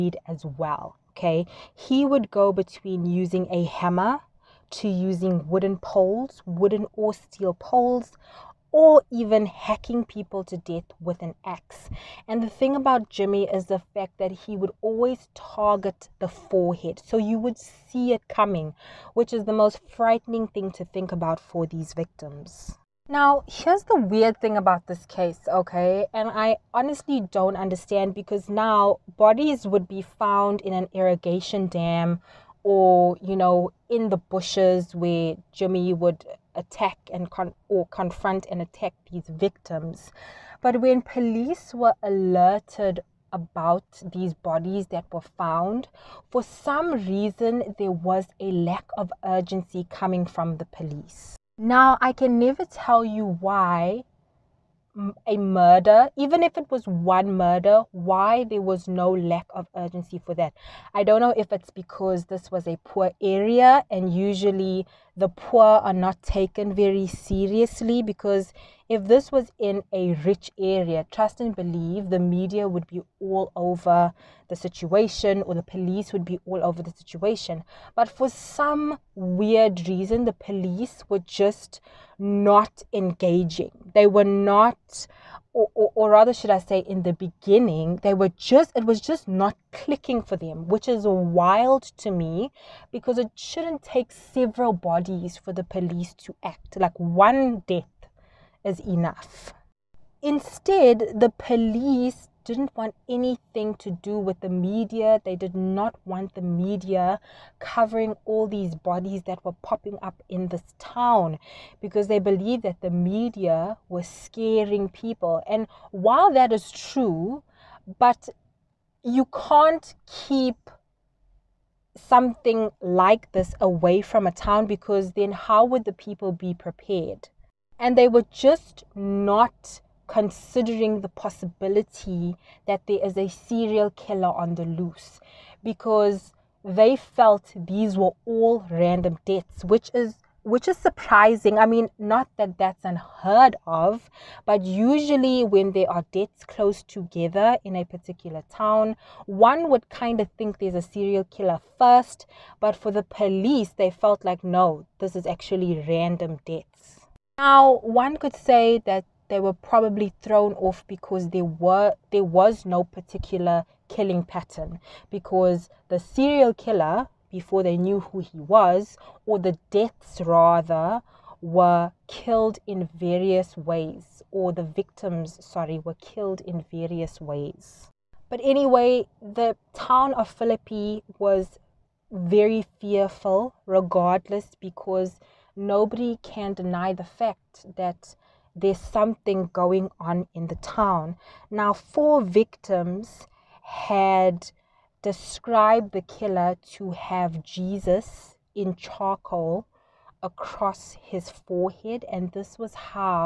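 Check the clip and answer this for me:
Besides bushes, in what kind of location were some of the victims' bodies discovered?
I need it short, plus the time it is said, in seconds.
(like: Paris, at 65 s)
Irrigation dam, at 30 s.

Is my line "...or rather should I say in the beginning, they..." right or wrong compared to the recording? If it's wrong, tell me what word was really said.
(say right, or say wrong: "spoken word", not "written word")
right.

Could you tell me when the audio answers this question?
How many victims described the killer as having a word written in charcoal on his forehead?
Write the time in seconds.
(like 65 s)
191 s.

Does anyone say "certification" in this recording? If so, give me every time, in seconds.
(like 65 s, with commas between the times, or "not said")
not said.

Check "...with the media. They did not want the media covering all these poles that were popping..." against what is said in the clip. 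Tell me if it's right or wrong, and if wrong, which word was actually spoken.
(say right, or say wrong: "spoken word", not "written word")
wrong: "bodies", not "poles".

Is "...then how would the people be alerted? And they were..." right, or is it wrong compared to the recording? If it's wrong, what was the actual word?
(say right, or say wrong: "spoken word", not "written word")
wrong: "prepared", not "alerted".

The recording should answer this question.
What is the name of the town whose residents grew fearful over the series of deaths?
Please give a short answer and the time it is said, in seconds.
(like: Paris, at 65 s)
Philippi, at 180 s.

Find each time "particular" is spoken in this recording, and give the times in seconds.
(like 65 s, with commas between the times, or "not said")
147 s, 162 s.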